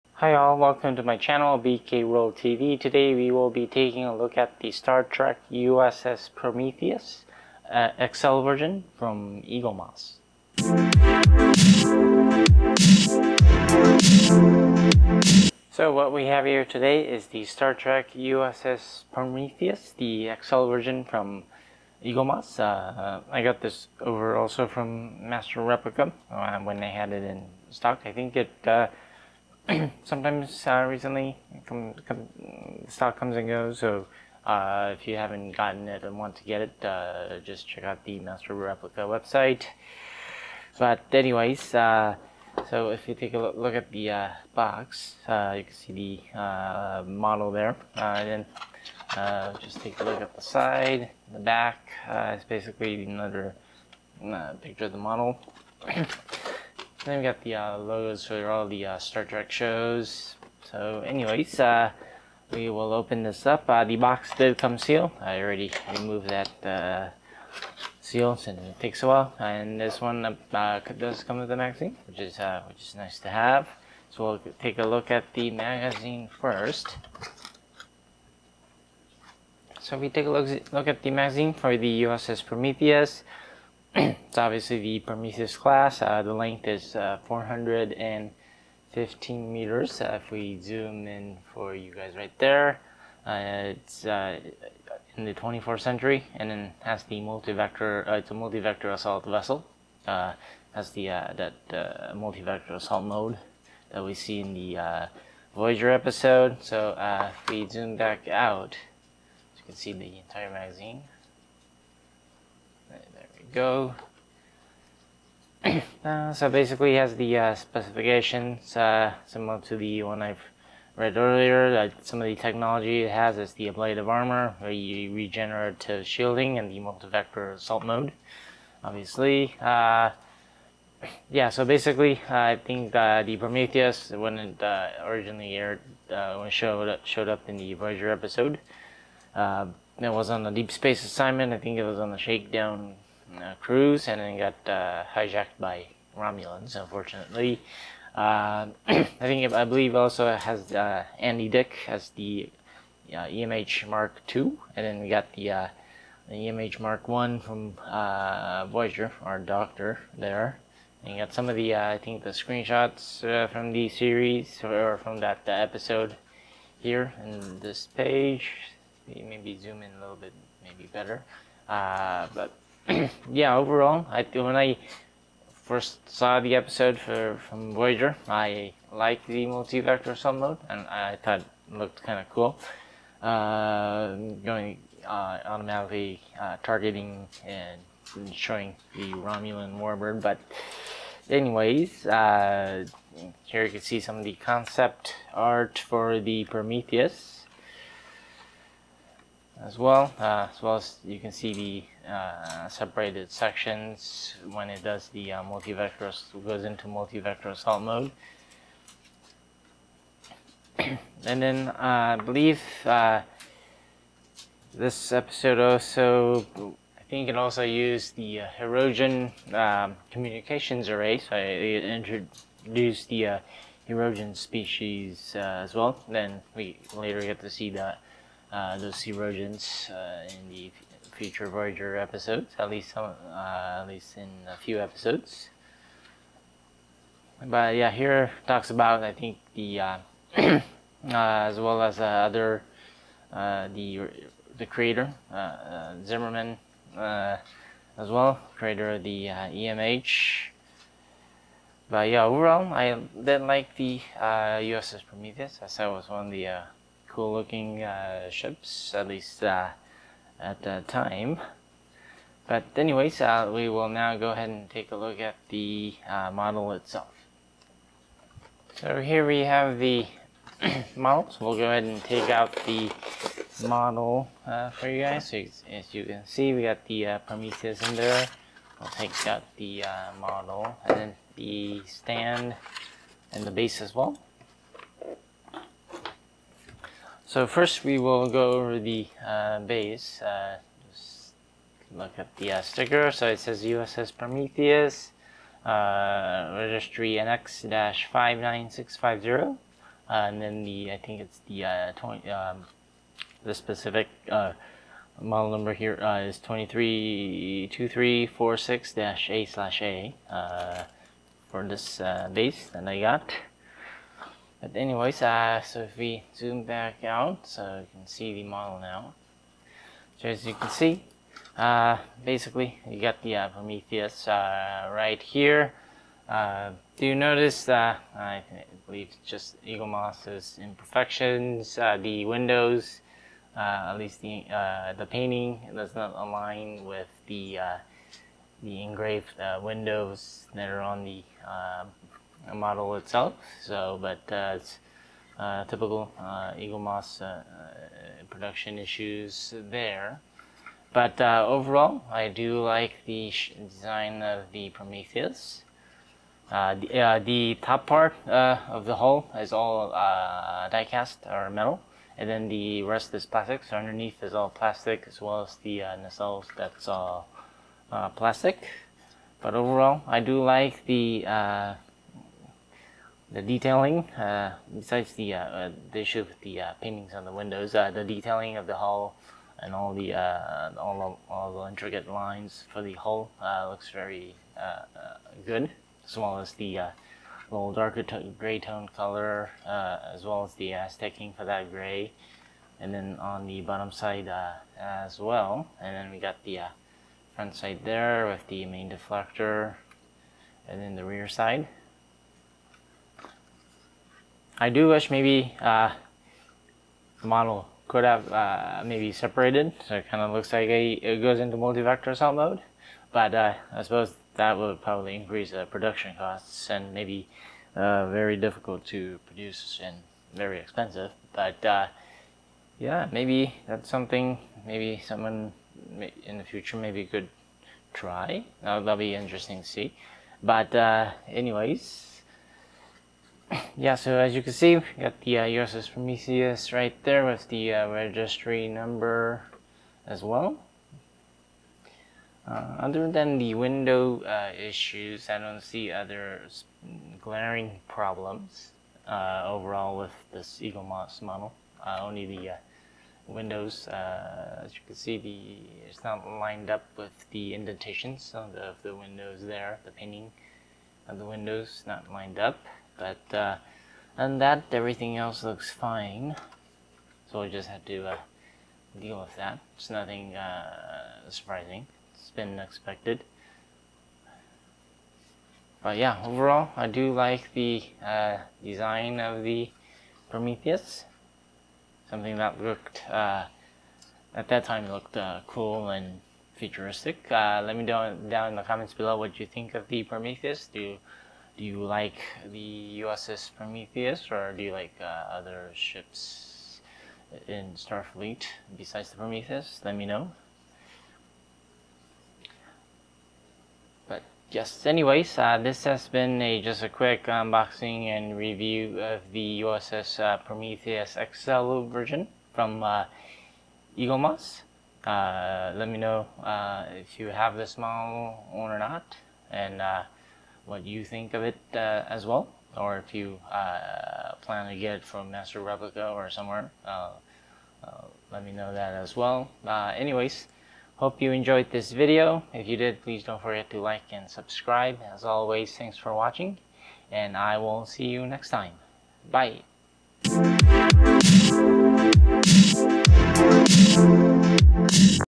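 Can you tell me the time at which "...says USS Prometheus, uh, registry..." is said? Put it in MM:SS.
04:53.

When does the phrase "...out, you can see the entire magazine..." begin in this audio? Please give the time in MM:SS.
01:48.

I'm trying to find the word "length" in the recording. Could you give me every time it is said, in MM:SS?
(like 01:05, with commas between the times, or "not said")
01:26.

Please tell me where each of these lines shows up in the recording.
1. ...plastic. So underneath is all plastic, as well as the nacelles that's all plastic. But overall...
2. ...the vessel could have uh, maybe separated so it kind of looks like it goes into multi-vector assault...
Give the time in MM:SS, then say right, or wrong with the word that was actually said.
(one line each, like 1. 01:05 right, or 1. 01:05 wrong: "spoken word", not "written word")
1. 06:03 right
2. 06:47 wrong: "model", not "vessel".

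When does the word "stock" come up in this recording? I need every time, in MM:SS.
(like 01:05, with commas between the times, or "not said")
00:27, 00:32.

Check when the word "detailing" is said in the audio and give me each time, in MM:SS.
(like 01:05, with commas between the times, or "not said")
06:13, 06:18.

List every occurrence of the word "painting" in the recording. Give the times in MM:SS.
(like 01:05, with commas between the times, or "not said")
05:35, 06:16, 07:39.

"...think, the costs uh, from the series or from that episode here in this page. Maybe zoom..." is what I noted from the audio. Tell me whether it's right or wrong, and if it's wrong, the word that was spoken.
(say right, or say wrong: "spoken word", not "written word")
wrong: "screenshots", not "costs".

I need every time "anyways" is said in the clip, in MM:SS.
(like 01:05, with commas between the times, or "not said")
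00:41, 01:01, 03:11, 04:22, 05:14, 07:11, 08:24, 08:49.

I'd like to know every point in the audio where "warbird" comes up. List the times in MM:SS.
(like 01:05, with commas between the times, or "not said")
03:09.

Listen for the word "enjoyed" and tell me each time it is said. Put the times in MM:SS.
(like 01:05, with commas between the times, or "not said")
08:51.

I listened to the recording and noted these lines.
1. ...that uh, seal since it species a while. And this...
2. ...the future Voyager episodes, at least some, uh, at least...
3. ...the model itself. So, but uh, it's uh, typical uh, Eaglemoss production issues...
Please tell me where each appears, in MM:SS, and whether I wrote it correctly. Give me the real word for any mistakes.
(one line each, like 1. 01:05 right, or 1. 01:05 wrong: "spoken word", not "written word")
1. 01:06 wrong: "takes", not "species"
2. 03:50 right
3. 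05:41 right.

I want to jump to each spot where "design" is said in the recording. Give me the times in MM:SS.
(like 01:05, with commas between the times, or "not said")
05:53, 07:58.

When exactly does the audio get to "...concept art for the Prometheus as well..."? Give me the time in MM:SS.
03:14.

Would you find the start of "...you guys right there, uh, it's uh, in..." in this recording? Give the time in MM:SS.
01:31.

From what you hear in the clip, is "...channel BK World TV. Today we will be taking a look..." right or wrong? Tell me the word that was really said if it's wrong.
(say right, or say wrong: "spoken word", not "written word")
right.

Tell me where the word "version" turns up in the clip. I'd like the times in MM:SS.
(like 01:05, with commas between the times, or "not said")
00:08, 00:20, 08:31.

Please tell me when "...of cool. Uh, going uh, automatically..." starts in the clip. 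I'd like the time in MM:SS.
03:02.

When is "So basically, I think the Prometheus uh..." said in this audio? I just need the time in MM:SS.
02:11.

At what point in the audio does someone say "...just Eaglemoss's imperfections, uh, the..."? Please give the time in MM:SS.
05:29.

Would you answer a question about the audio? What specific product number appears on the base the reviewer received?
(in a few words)
232346-A/A.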